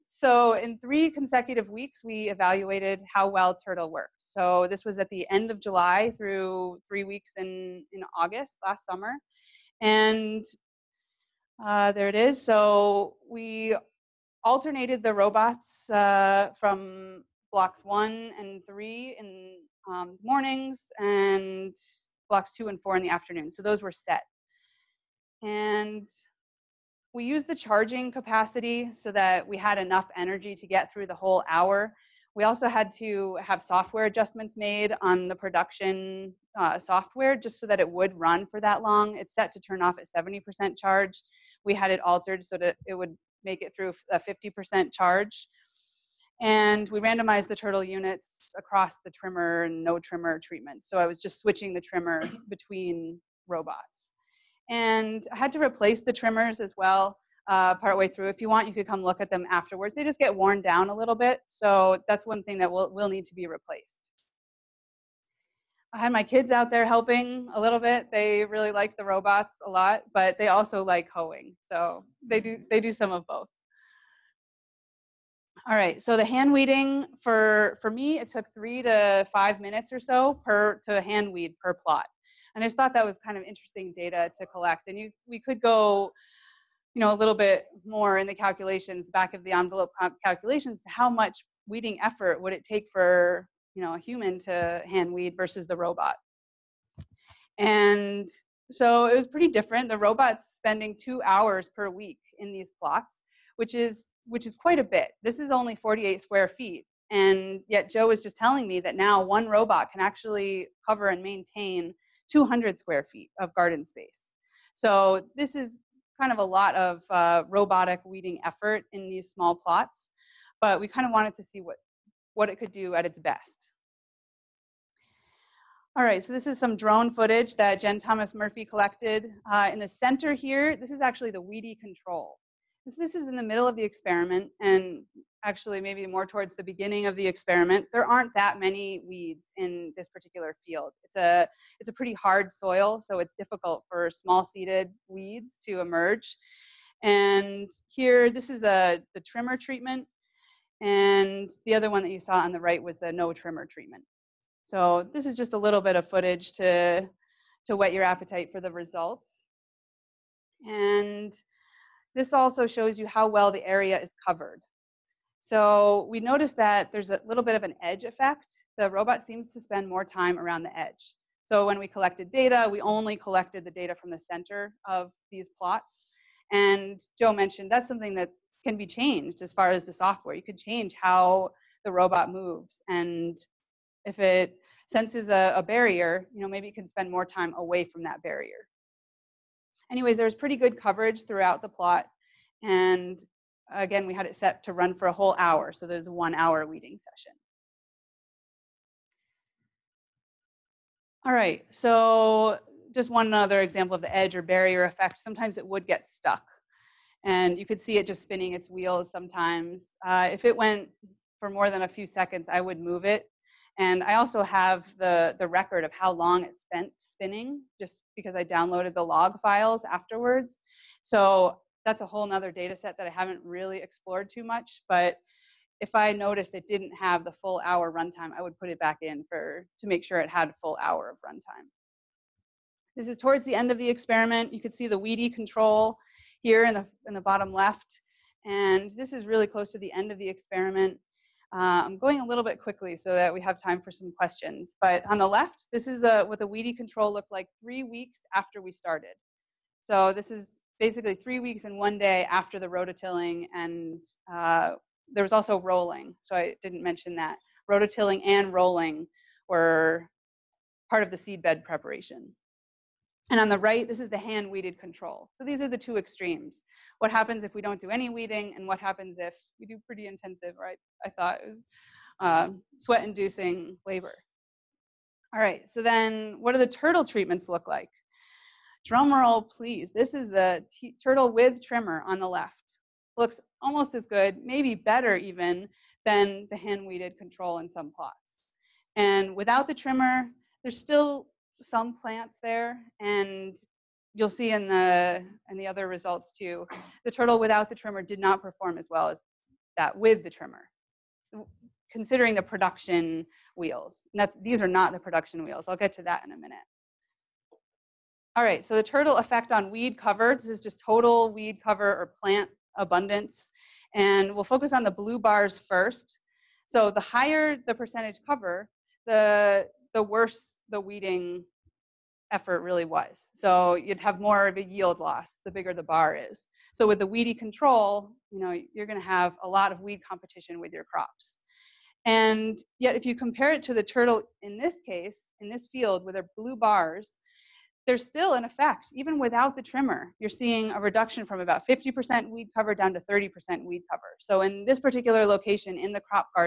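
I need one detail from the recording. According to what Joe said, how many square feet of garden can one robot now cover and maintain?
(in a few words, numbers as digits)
200.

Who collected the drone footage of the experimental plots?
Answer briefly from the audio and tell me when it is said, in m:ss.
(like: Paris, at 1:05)
Jen Thomas Murphy, at 2:07.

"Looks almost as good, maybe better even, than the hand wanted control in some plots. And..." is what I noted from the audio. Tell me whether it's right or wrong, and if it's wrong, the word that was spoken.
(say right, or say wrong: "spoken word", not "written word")
wrong: "weeded", not "wanted".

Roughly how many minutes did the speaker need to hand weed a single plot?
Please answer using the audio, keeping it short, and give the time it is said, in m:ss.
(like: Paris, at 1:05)
3 to 5 minutes, at 1:18.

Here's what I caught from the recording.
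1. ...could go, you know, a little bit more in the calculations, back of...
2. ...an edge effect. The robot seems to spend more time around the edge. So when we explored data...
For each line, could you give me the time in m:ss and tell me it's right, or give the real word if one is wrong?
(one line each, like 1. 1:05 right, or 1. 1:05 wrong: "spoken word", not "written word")
1. 1:25 right
2. 2:47 wrong: "collected", not "explored".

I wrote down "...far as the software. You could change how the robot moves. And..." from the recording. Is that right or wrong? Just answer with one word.
right.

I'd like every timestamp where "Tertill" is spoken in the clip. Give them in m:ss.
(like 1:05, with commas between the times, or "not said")
0:03, 4:36, 4:41, 4:57, 5:08, 5:33.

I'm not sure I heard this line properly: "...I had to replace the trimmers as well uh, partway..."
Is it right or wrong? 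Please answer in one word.
right.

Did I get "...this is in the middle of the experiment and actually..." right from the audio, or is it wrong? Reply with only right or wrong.
right.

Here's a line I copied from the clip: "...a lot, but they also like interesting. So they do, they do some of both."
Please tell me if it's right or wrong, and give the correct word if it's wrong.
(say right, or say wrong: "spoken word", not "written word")
wrong: "hoeing", not "interesting".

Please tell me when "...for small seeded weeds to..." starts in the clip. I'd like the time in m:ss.
2:23.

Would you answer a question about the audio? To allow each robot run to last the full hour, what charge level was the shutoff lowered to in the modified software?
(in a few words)
50%.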